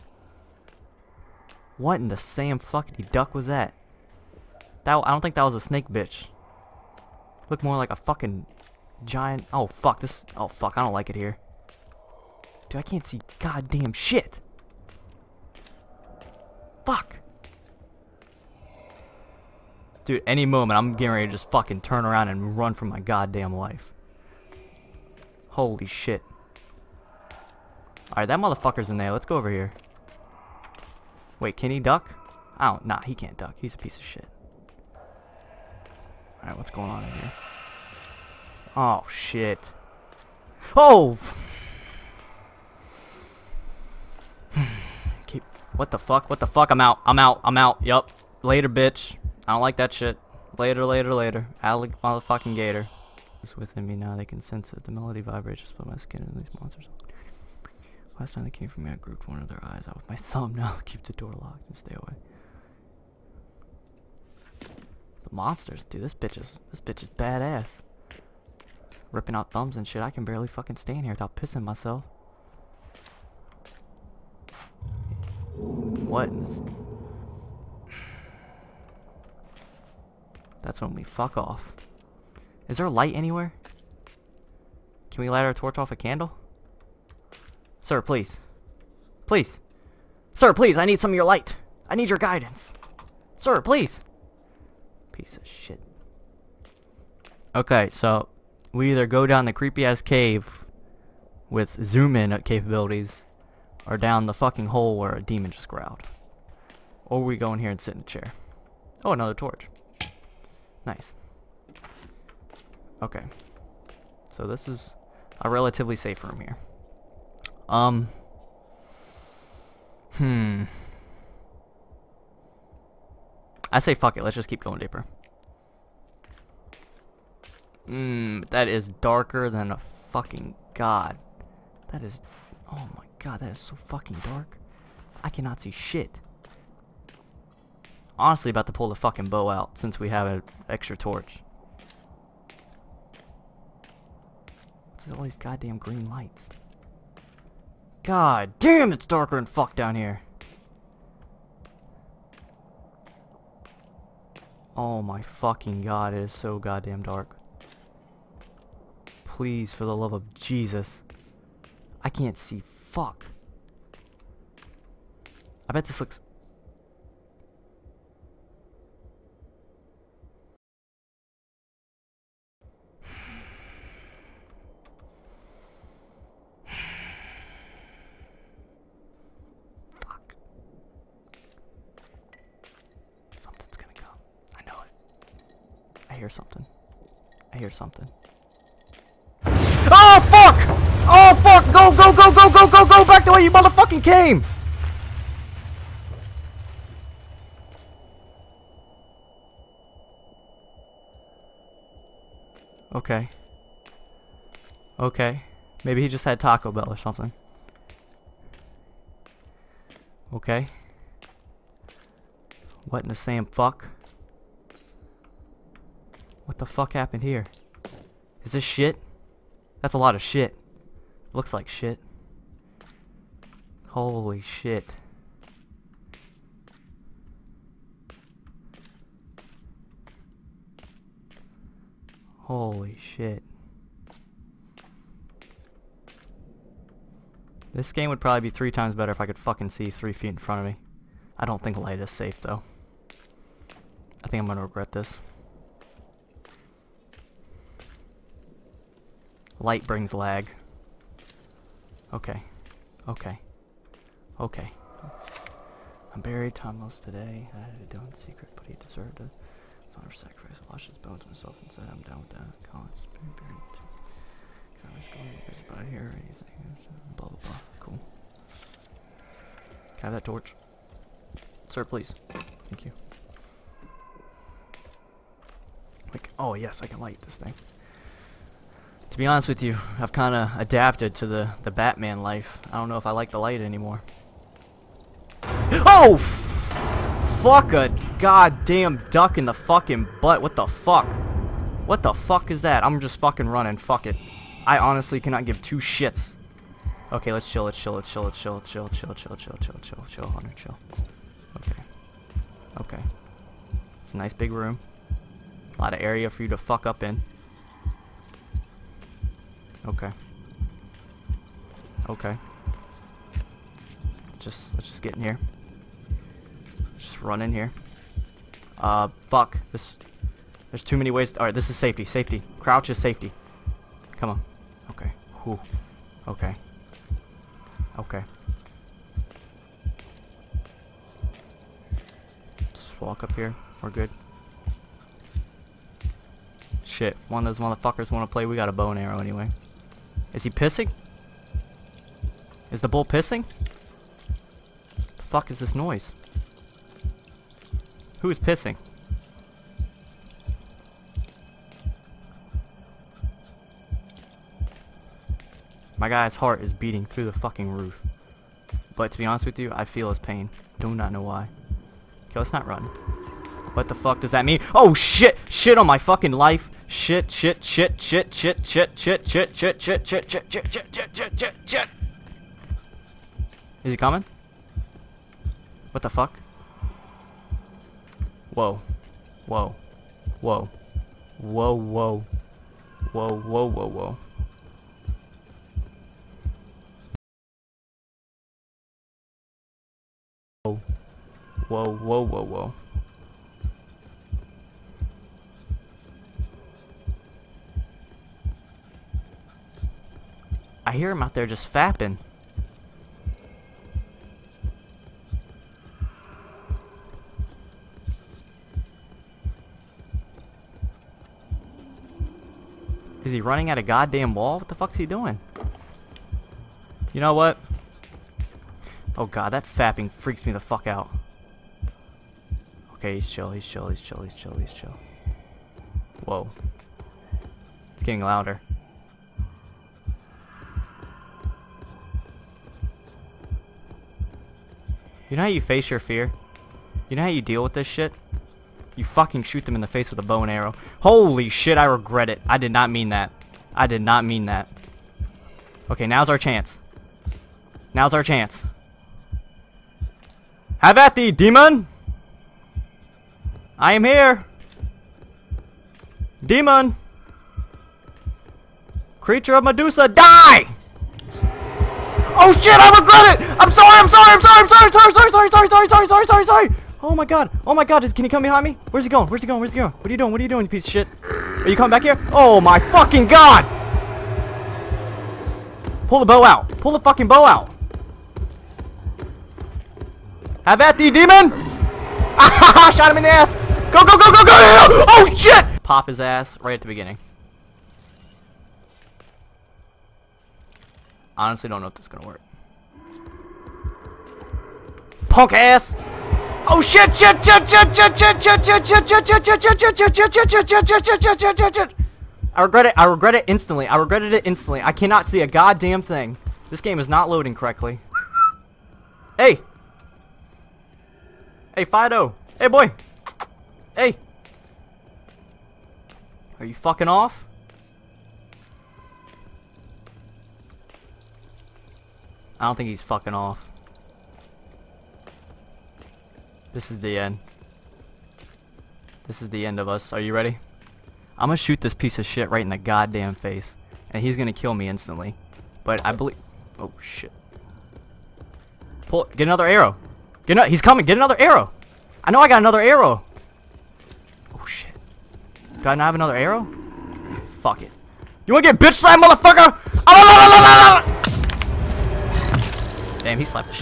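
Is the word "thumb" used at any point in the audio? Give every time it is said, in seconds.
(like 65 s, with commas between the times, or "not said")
60 s, 69 s.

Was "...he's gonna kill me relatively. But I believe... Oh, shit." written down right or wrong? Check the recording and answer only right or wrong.
wrong.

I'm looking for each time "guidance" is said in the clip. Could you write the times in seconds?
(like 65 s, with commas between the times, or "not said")
92 s.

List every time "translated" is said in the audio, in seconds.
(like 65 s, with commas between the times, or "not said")
not said.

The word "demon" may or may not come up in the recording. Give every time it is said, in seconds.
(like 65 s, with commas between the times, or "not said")
105 s, 451 s, 456 s, 481 s.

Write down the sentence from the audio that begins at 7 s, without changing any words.
Looked more like a fucking giant...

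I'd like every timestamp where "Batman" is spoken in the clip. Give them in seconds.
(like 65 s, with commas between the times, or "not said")
281 s.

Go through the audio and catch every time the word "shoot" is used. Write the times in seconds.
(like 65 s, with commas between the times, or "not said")
439 s, 531 s.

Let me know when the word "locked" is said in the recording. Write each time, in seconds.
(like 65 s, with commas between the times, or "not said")
61 s.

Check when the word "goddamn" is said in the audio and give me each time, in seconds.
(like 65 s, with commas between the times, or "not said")
13 s, 22 s, 145 s, 156 s, 288 s, 413 s, 532 s.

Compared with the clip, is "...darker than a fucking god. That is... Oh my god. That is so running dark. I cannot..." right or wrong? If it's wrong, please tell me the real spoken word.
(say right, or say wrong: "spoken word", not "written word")
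wrong: "fucking", not "running".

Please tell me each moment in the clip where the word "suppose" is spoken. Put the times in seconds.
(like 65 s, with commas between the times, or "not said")
not said.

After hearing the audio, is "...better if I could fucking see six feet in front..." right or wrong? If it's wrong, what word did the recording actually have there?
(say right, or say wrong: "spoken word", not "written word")
wrong: "three", not "six".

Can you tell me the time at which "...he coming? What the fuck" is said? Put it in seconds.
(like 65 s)
373 s.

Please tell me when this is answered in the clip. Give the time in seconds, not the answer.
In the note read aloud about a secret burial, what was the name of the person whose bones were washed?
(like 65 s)
256 s.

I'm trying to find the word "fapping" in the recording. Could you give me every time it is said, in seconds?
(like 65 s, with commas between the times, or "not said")
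401 s, 419 s.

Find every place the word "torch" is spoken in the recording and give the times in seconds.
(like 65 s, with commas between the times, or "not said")
85 s, 109 s, 140 s, 270 s.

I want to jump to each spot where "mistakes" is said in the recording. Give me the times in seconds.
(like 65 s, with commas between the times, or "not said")
not said.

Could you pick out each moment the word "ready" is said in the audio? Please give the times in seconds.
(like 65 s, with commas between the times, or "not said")
21 s, 530 s.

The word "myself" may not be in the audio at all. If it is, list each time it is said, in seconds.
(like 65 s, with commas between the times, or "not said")
71 s, 261 s.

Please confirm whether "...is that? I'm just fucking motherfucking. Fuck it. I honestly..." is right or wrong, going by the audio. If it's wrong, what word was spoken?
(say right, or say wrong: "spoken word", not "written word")
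wrong: "running", not "motherfucking".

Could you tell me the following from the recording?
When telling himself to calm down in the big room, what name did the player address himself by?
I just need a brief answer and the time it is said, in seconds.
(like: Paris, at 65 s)
Hunter, at 300 s.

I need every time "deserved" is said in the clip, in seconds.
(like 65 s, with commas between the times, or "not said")
258 s.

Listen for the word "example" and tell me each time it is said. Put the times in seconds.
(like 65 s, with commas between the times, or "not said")
not said.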